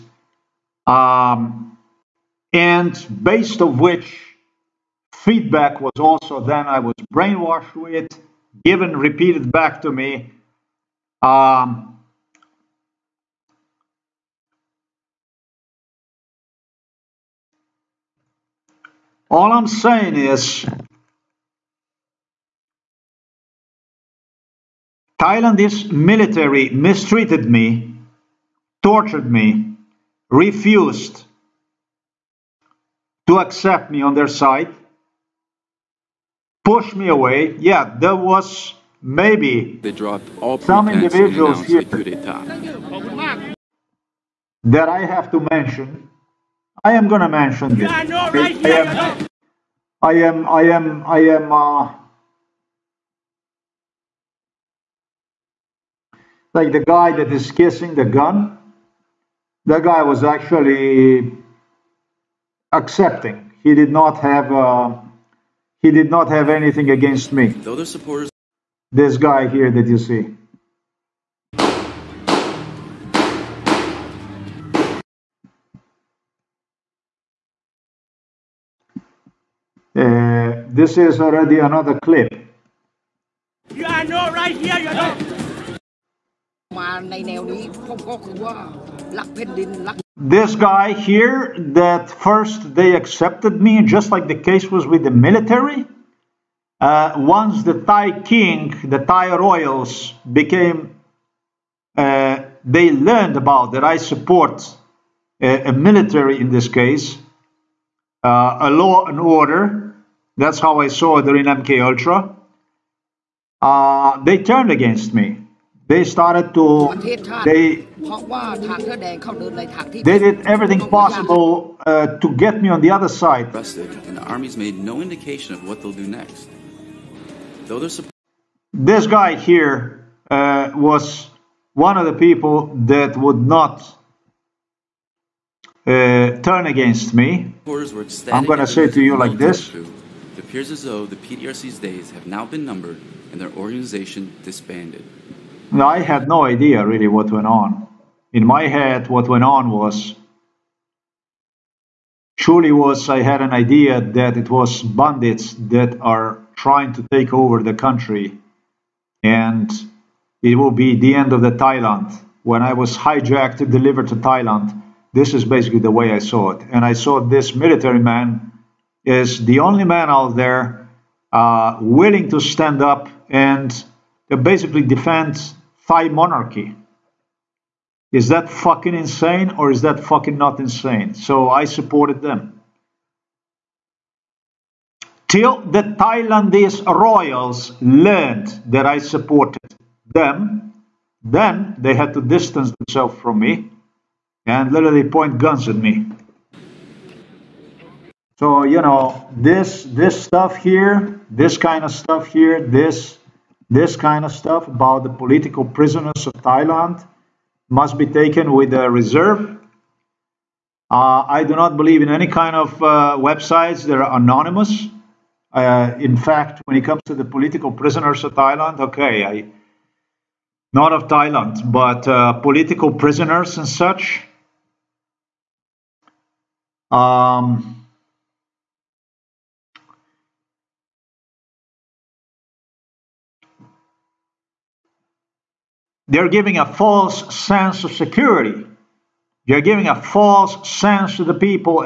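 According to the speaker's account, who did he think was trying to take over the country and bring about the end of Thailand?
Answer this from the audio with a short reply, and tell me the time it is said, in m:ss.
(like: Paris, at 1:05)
bandits, at 2:34.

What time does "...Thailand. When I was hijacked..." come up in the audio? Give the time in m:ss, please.
2:41.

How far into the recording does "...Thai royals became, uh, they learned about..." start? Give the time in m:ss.
1:38.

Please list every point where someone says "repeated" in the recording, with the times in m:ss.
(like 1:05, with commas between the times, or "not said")
0:08.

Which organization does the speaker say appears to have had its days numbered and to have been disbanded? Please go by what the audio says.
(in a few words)
PDRC.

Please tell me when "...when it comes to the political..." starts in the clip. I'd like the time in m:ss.
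3:36.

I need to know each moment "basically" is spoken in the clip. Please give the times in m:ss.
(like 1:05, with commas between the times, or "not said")
2:45, 2:54.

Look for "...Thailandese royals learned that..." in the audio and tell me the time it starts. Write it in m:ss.
3:05.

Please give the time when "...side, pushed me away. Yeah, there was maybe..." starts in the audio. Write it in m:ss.
0:34.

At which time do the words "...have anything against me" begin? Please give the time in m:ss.
1:06.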